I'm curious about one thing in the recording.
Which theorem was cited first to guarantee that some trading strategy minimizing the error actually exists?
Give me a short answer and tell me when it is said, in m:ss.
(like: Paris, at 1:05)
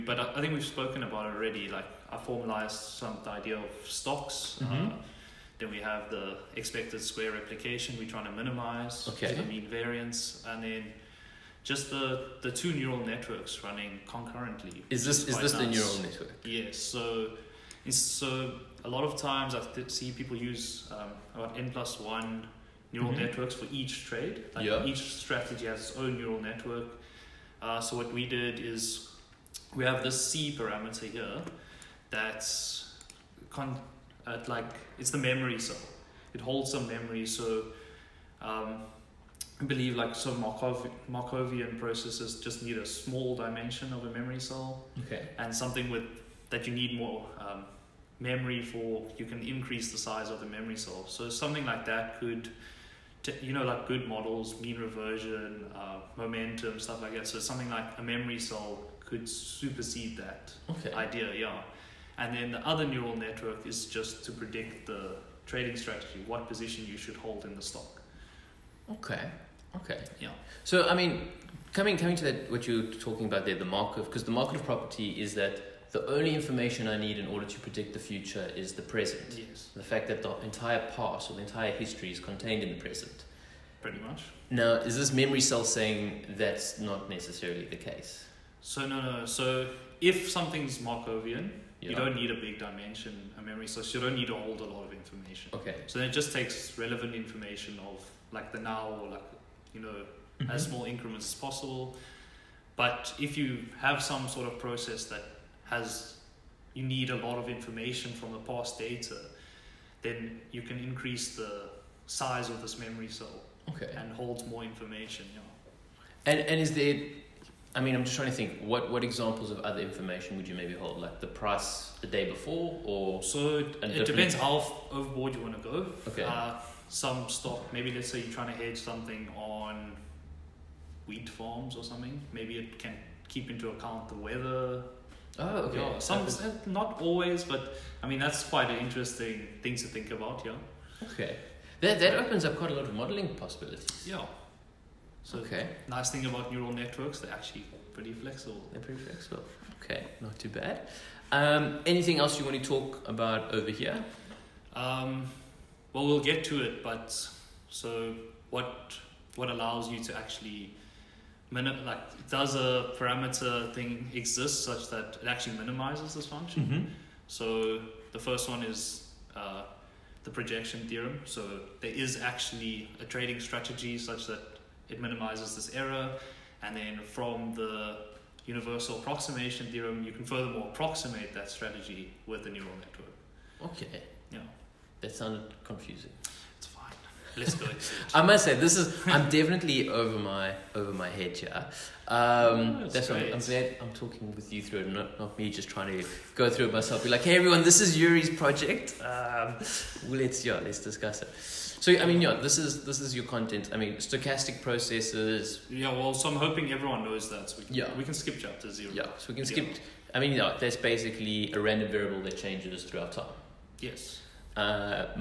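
projection theorem, at 2:50.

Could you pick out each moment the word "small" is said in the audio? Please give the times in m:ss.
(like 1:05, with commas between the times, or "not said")
0:42, 1:40.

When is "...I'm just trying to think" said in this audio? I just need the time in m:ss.
1:57.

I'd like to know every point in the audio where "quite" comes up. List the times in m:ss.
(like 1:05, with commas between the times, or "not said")
2:18, 2:22.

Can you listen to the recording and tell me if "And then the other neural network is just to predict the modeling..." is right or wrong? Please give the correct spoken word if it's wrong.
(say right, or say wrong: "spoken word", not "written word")
wrong: "trading", not "modeling".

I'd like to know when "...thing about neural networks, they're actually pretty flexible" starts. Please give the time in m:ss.
2:26.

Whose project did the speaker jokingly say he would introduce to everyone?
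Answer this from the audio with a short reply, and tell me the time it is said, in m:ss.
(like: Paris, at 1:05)
Yuri, at 3:17.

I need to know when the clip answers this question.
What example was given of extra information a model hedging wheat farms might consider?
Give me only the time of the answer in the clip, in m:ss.
2:14.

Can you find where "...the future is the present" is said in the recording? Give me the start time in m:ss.
1:17.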